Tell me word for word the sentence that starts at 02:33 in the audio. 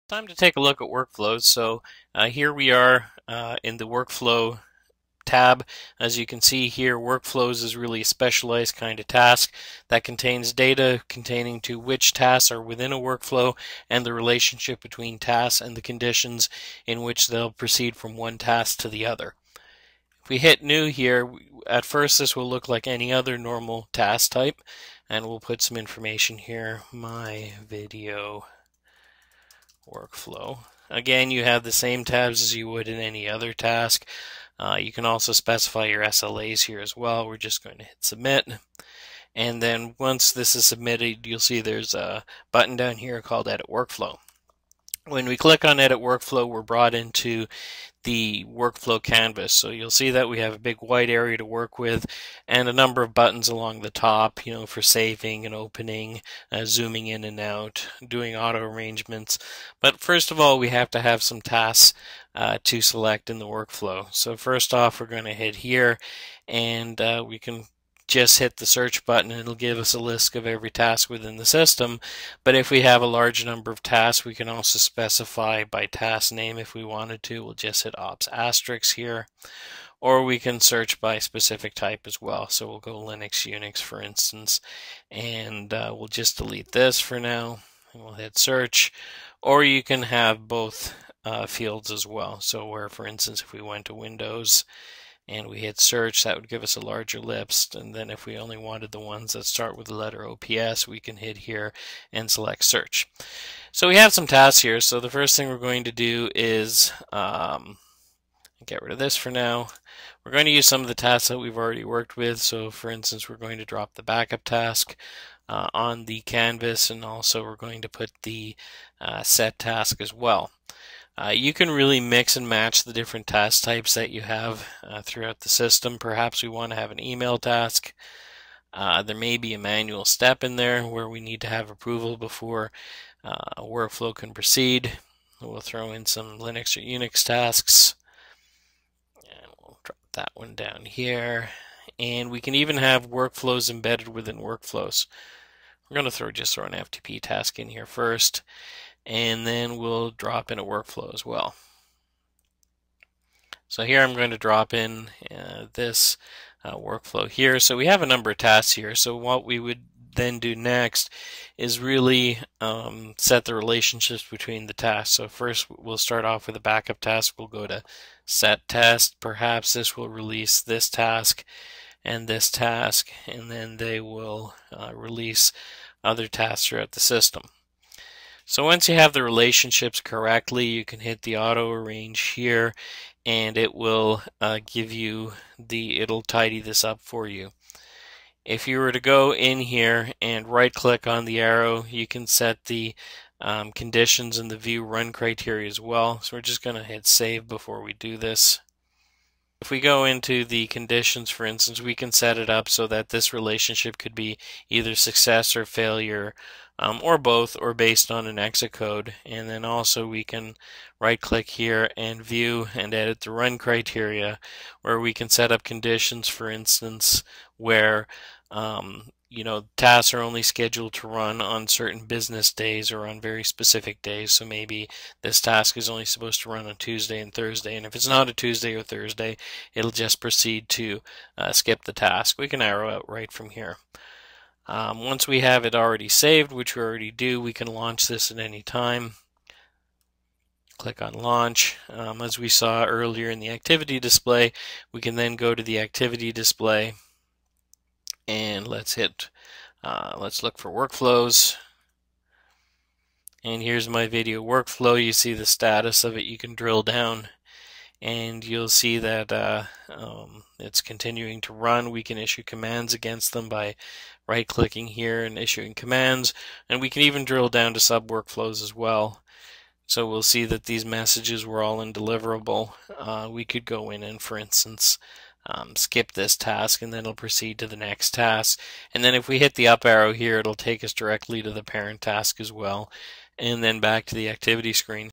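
So here I'm going to drop in uh, this uh, workflow here.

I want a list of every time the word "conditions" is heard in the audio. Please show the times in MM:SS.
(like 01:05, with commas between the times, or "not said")
00:15, 03:13, 03:20, 03:35.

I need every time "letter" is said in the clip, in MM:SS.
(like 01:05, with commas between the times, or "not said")
01:39.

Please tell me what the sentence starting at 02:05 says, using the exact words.
Perhaps we want to have an email task.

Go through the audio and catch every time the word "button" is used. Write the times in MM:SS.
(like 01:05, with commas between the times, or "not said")
00:42, 00:53, 01:09.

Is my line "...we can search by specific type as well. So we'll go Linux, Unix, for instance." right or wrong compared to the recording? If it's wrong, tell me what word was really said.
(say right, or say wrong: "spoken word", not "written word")
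right.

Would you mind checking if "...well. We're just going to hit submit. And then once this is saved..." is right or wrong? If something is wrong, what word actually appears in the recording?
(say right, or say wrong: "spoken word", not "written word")
wrong: "submitted", not "saved".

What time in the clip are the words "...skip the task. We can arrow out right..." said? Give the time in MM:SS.
03:51.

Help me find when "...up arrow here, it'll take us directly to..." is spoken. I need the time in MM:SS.
04:39.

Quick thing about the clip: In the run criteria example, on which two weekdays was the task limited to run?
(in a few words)
Tuesday and Thursday.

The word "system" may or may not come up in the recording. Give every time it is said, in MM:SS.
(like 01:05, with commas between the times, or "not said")
01:11, 02:05, 02:56.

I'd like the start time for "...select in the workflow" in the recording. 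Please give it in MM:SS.
01:02.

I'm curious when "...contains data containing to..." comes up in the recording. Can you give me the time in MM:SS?
00:10.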